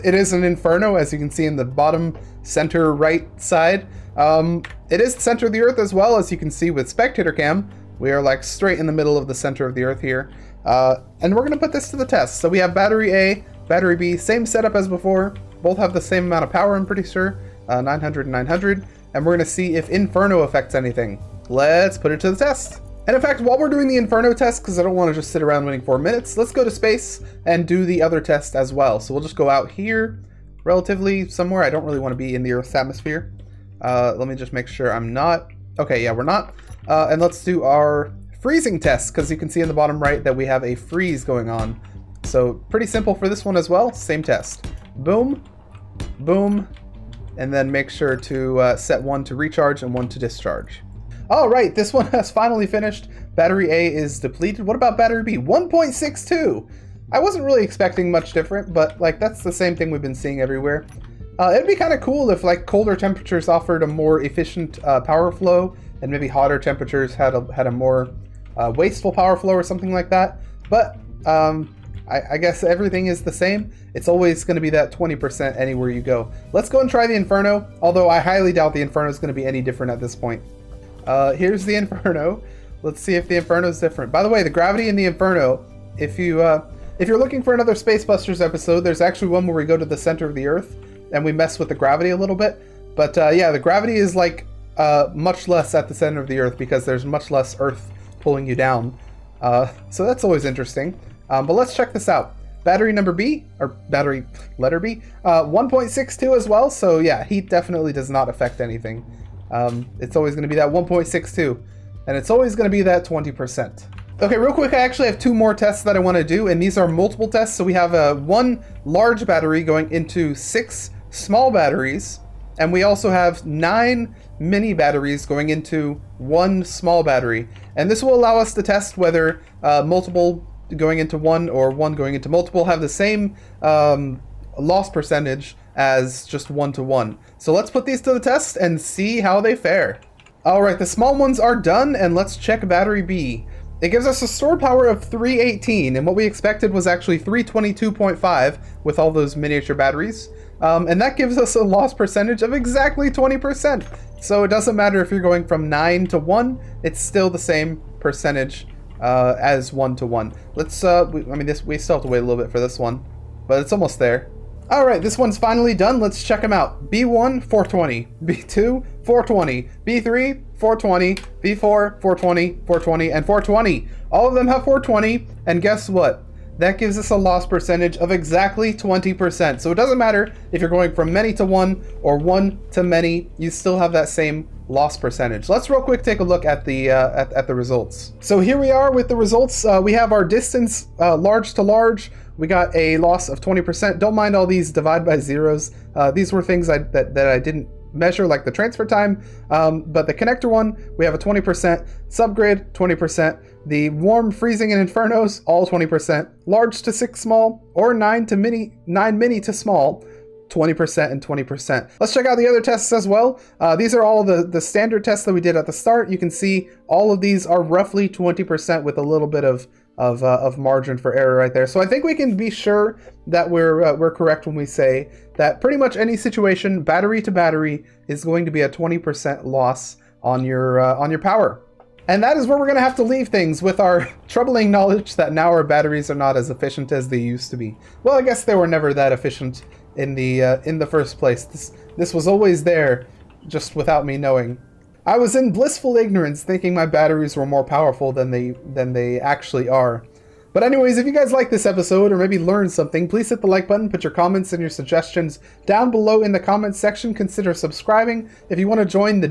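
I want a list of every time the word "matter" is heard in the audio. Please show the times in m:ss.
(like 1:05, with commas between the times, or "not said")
2:34, 2:59.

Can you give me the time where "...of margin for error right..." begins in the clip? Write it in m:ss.
3:40.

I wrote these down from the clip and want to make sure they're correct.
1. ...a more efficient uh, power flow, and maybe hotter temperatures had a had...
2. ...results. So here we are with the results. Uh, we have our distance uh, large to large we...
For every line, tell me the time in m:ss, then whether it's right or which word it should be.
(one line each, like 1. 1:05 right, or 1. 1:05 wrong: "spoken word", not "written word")
1. 1:03 right
2. 3:07 right.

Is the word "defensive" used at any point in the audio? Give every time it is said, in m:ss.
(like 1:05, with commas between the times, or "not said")
not said.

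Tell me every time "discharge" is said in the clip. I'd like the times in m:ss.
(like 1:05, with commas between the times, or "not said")
0:50.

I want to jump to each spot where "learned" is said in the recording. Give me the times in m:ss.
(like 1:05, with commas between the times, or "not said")
4:12.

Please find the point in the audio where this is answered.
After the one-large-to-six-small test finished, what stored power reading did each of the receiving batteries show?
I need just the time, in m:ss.
2:46.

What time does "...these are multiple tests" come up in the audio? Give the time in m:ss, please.
1:56.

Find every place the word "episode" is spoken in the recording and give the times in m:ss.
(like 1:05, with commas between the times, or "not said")
1:28, 4:11.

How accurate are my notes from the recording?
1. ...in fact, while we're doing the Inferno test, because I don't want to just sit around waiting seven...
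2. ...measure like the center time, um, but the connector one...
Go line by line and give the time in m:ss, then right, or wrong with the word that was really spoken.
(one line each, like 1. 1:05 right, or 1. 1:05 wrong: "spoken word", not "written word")
1. 0:23 wrong: "four", not "seven"
2. 3:17 wrong: "transfer", not "center".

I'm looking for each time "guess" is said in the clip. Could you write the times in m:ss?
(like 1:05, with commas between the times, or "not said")
1:12, 2:55, 3:58.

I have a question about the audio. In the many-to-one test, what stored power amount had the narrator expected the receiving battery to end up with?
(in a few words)
322.5.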